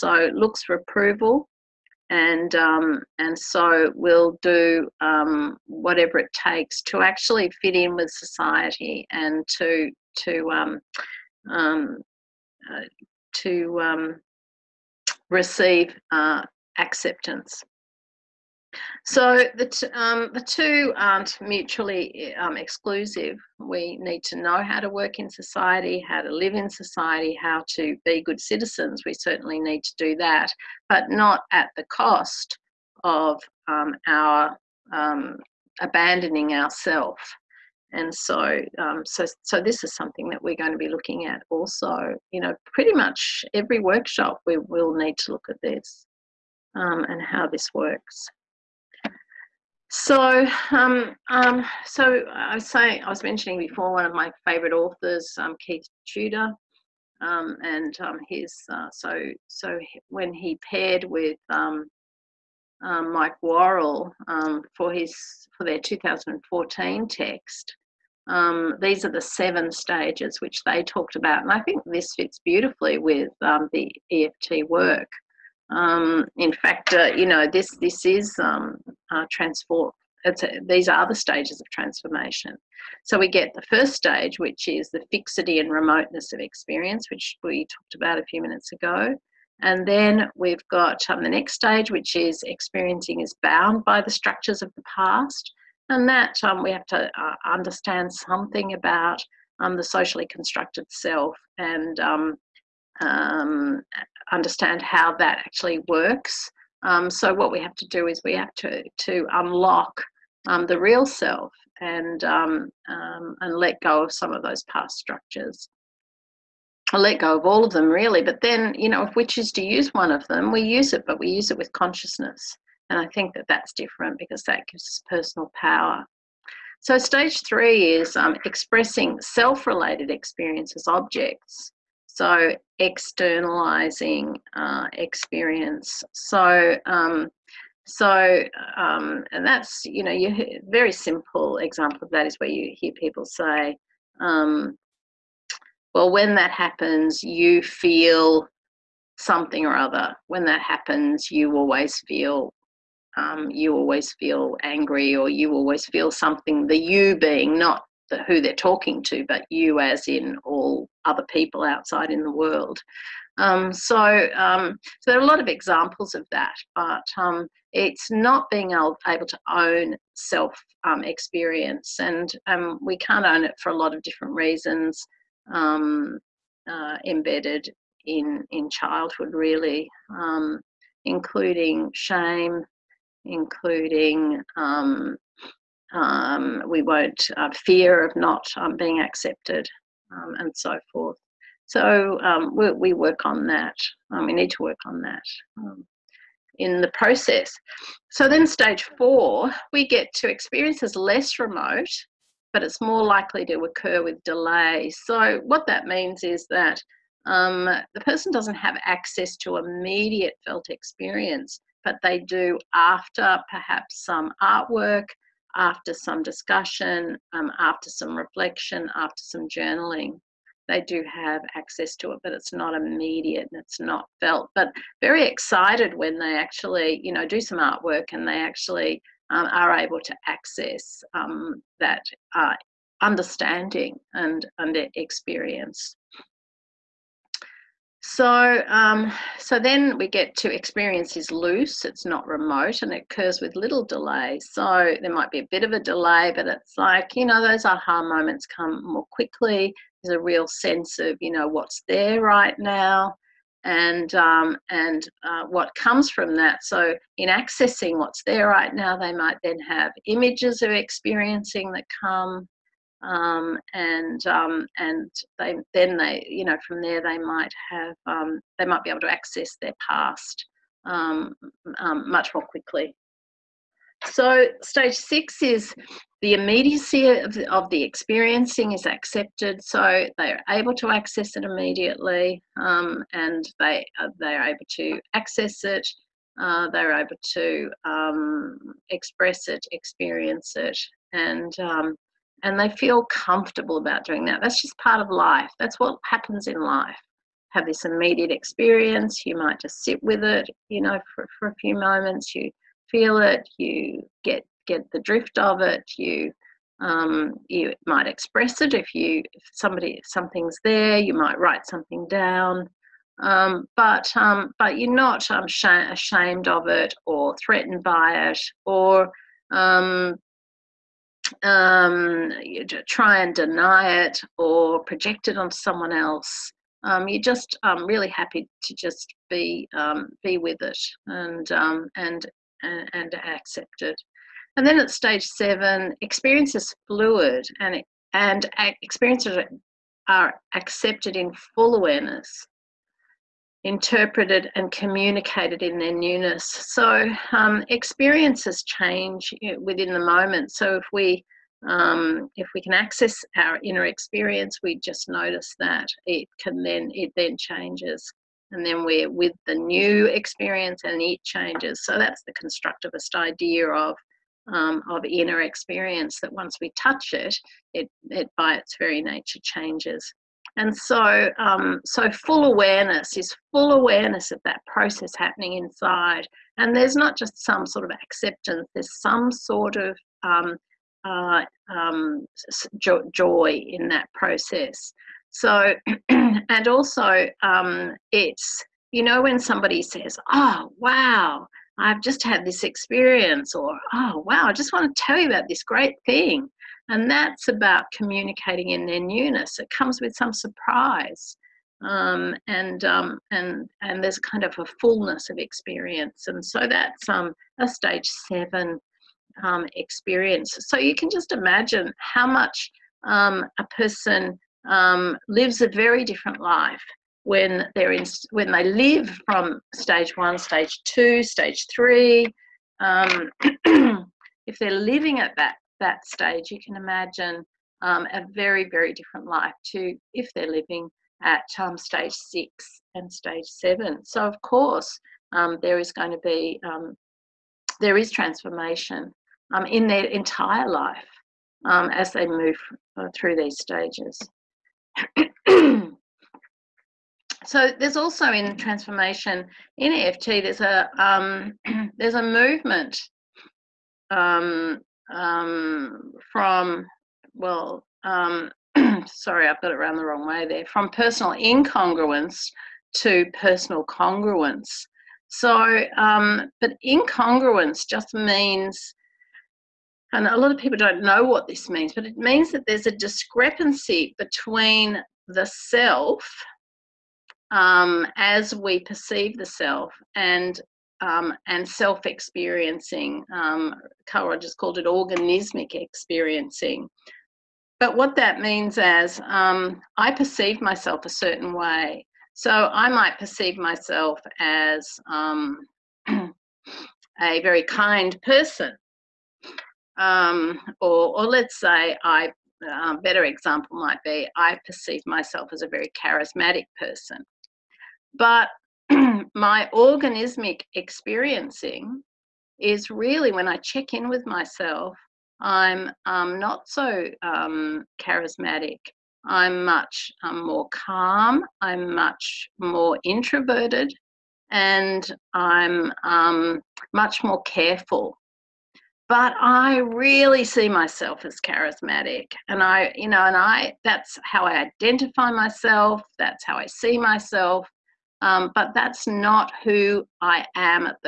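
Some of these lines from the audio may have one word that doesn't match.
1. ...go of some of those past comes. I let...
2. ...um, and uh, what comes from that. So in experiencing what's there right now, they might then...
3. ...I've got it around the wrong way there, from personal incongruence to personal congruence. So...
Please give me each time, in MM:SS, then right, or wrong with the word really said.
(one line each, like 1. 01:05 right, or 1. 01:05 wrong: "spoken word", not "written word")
1. 01:53 wrong: "structures", not "comes"
2. 04:14 wrong: "accessing", not "experiencing"
3. 07:39 right.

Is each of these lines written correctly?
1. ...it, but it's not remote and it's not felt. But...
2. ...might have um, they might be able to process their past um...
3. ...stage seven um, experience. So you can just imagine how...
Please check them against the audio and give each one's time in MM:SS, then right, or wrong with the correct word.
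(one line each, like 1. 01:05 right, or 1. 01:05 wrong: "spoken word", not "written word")
1. 03:42 wrong: "immediate", not "remote"
2. 04:27 wrong: "access", not "process"
3. 06:47 right.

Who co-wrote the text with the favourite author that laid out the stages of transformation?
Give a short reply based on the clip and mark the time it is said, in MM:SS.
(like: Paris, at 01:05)
Mike Worrall, at 01:02.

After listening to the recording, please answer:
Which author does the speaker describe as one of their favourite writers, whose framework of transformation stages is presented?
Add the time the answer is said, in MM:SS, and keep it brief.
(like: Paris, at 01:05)
Keith Tudor, at 00:55.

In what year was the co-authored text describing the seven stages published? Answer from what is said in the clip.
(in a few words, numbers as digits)
2014.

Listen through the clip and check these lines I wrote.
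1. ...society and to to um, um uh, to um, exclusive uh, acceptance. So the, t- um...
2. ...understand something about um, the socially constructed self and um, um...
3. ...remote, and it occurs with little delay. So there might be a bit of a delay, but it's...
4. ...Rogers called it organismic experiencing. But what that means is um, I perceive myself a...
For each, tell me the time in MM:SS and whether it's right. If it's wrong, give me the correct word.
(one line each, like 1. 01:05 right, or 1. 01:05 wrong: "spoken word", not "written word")
1. 00:08 wrong: "receive", not "exclusive"
2. 01:37 right
3. 04:02 right
4. 08:04 right.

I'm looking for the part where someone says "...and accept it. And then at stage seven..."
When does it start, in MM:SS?
05:32.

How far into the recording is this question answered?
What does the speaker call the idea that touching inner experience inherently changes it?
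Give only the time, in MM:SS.
06:02.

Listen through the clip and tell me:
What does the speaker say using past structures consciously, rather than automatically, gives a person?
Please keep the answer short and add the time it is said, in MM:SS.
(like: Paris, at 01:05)
personal power, at 02:05.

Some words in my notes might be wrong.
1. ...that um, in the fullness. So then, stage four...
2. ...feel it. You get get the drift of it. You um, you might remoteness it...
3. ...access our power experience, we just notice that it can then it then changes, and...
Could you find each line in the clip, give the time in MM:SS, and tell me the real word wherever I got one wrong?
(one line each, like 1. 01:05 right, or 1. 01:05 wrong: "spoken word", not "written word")
1. 03:15 wrong: "process", not "fullness"
2. 05:02 wrong: "express", not "remoteness"
3. 05:52 wrong: "inner", not "power".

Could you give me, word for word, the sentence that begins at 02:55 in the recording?
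Um, uh, embedded in in childhood, really, including shame, including we won't uh, fear of not being accepted, um, and so forth.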